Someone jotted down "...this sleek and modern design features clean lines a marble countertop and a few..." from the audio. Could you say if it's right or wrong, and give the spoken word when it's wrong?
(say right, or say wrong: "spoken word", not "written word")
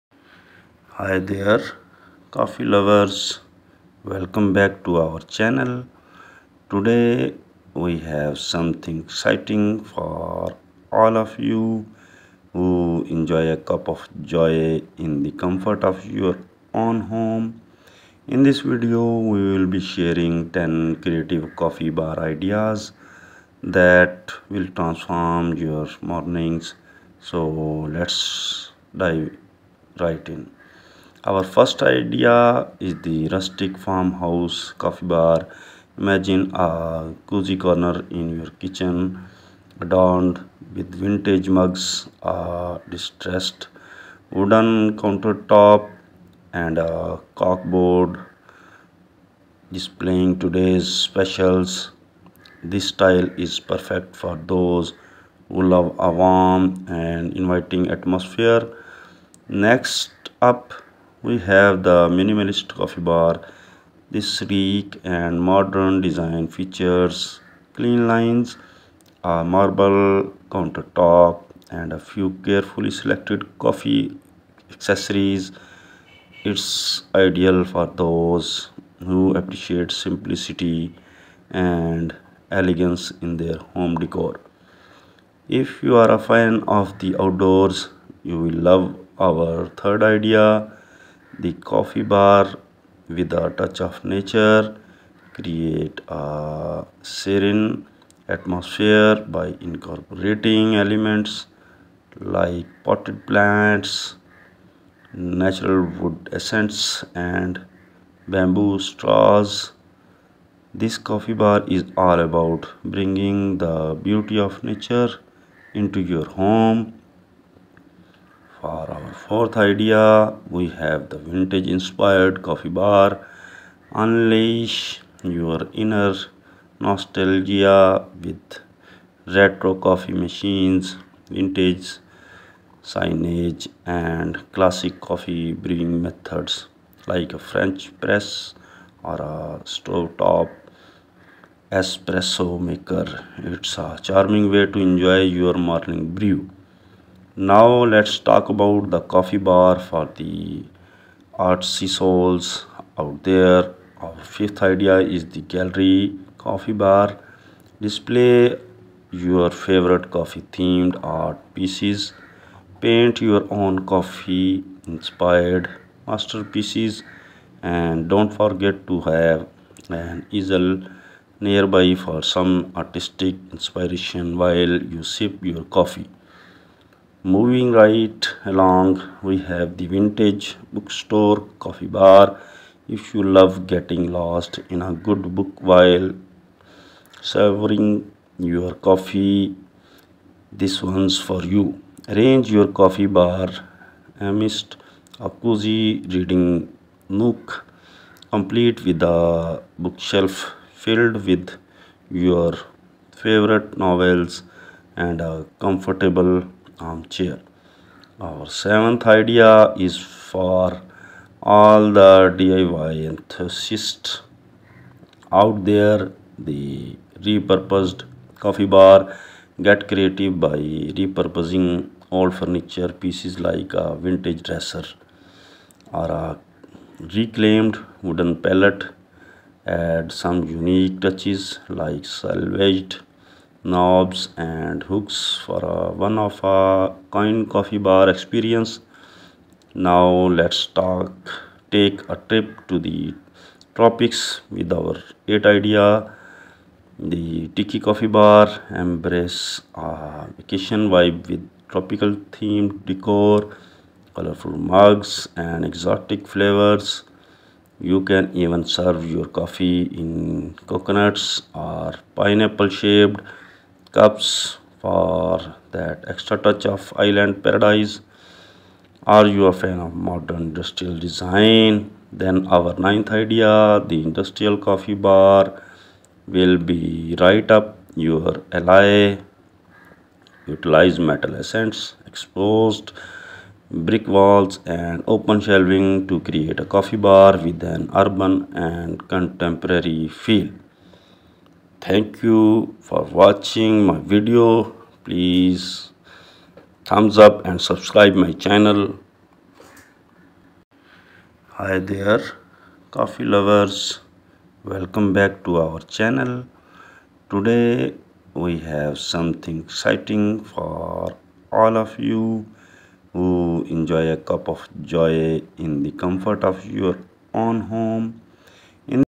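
right.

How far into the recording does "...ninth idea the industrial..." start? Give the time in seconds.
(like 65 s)
272 s.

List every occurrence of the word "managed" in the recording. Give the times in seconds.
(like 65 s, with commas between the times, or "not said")
not said.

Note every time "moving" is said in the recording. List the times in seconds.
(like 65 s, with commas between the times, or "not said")
177 s.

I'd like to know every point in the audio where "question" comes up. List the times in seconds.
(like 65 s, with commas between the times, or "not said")
not said.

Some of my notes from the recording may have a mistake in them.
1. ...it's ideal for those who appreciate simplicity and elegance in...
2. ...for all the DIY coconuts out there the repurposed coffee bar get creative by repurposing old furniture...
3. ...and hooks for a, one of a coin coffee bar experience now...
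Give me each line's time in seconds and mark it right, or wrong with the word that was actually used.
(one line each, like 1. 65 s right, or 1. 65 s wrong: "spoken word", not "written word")
1. 76 s right
2. 210 s wrong: "enthusiasts", not "coconuts"
3. 234 s right.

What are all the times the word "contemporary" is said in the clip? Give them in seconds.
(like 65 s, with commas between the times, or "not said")
289 s.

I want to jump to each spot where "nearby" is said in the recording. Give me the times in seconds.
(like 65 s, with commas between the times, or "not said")
171 s.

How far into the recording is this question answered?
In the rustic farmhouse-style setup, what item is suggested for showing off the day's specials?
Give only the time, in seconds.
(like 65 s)
47 s.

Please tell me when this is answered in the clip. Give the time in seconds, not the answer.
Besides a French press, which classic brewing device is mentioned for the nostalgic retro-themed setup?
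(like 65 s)
139 s.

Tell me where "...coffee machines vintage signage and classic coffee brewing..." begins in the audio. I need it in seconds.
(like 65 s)
129 s.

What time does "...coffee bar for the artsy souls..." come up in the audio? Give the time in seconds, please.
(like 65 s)
148 s.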